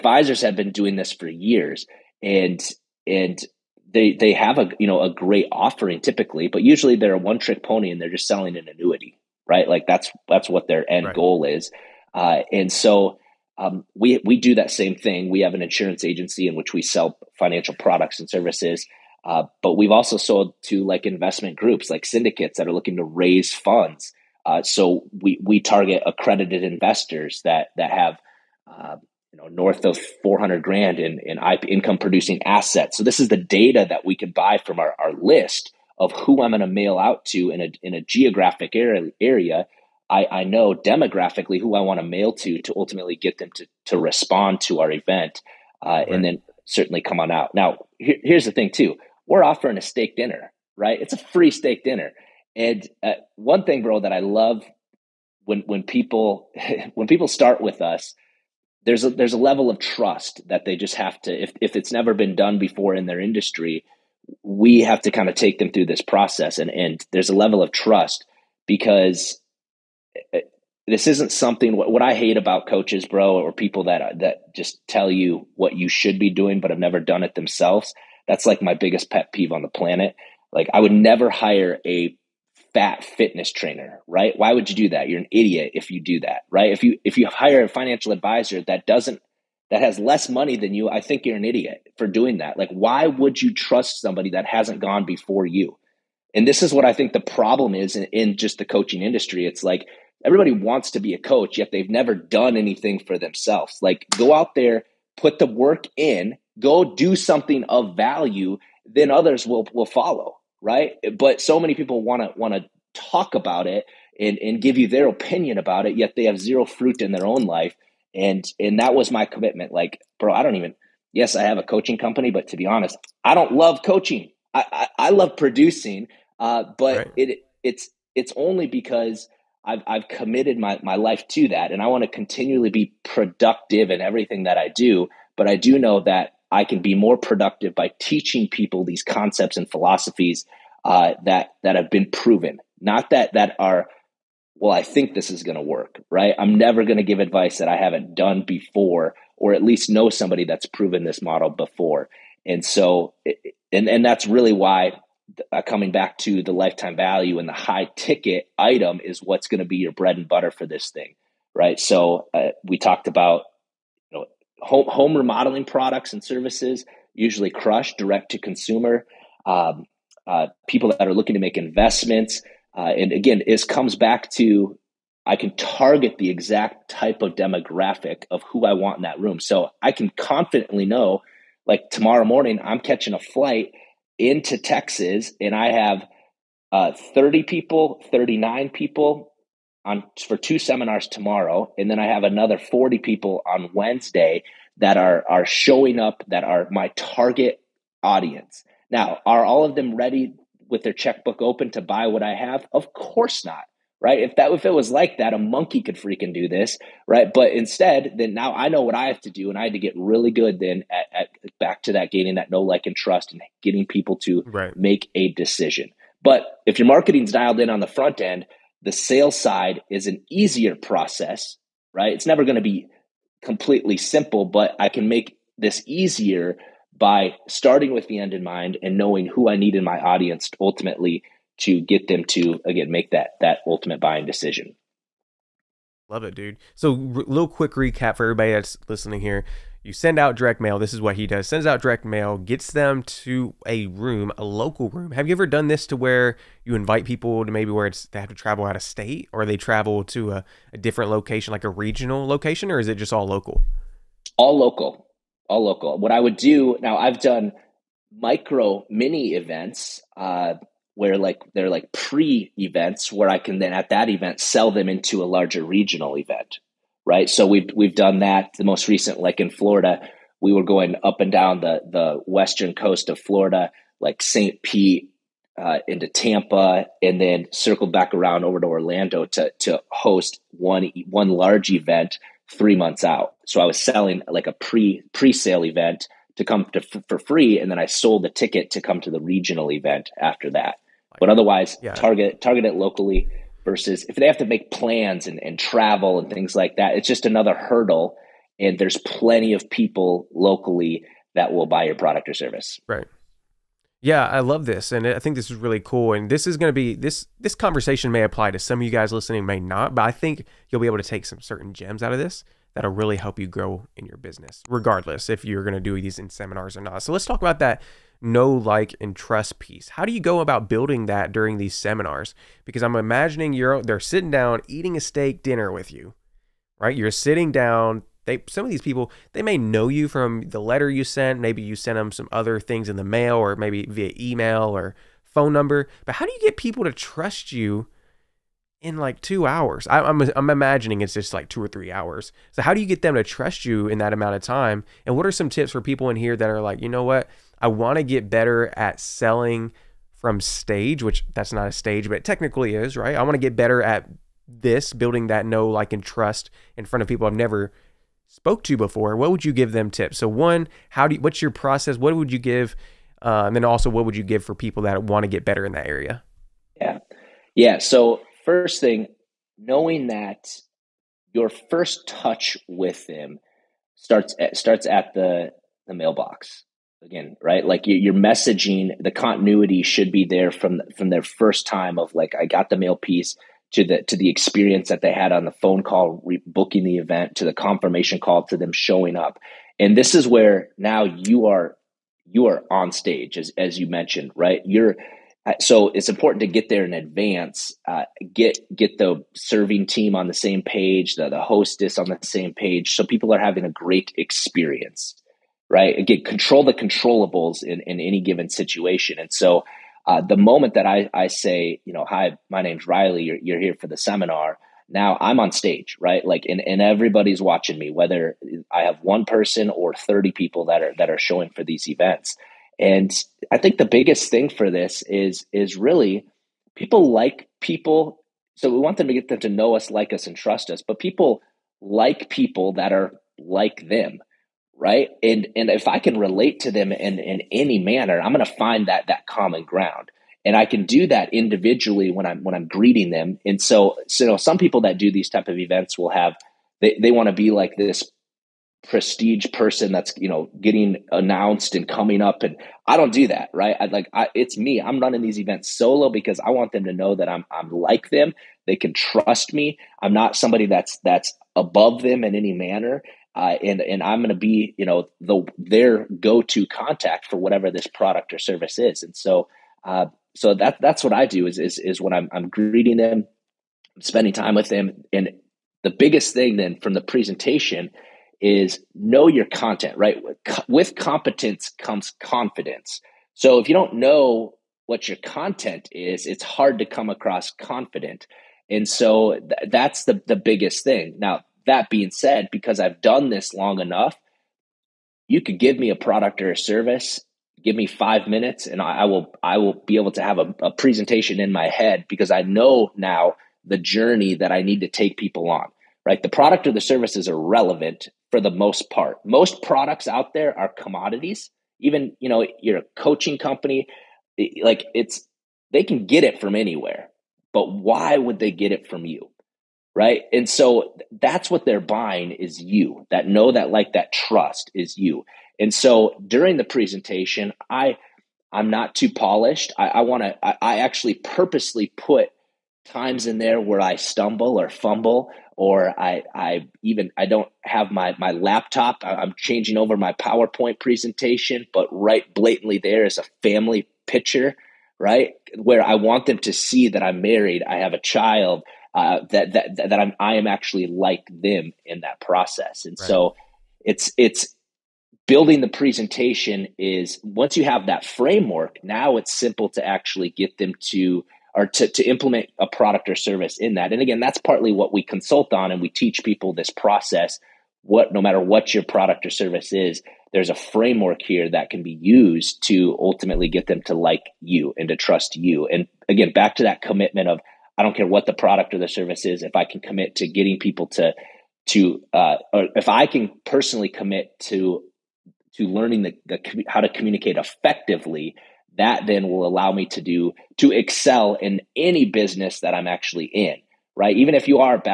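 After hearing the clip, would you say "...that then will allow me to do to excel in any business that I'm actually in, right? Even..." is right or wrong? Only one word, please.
right.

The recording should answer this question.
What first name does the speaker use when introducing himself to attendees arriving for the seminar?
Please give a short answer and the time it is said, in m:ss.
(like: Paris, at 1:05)
Rylee, at 6:52.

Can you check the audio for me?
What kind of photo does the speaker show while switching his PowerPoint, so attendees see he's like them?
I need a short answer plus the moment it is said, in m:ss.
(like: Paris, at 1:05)
Family picture, at 9:03.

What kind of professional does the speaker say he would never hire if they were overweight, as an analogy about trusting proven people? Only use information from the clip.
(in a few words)
Fitness trainer.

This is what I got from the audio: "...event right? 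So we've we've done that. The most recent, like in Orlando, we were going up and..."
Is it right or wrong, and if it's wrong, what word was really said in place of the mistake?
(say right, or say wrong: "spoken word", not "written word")
wrong: "Florida", not "Orlando".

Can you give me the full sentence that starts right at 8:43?
That know, that like, that trust is you.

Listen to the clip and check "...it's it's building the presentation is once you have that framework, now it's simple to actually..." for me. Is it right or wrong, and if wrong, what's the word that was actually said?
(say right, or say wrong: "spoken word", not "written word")
right.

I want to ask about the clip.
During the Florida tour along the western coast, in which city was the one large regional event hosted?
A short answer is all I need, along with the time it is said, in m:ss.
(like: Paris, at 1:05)
Orlando, at 4:38.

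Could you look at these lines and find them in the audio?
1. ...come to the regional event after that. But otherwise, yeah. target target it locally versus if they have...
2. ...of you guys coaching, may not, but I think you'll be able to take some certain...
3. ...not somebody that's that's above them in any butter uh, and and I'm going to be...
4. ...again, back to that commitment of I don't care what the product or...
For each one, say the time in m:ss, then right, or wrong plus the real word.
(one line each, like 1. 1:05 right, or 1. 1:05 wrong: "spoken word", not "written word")
1. 4:48 right
2. 5:08 wrong: "listening", not "coaching"
3. 7:40 wrong: "manner", not "butter"
4. 9:36 right.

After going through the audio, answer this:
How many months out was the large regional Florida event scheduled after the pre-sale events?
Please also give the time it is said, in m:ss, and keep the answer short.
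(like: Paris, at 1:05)
3 months, at 4:42.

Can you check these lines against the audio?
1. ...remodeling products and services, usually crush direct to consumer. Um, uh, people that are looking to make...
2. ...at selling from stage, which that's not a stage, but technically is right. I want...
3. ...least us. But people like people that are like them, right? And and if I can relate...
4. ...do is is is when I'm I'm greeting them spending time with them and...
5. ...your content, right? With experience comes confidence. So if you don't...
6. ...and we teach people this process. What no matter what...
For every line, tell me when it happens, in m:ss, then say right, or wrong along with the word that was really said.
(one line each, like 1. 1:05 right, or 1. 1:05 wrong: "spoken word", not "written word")
1. 2:45 right
2. 5:48 right
3. 7:10 wrong: "trust", not "least"
4. 7:51 right
5. 7:59 wrong: "competence", not "experience"
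6. 9:25 right.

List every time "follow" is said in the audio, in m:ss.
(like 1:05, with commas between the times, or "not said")
1:49.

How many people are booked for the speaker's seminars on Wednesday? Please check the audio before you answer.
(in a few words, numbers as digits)
40.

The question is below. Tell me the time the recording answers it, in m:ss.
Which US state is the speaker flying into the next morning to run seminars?
3:04.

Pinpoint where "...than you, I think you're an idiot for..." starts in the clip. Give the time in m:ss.
1:30.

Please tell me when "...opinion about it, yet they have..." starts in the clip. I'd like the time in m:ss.
1:55.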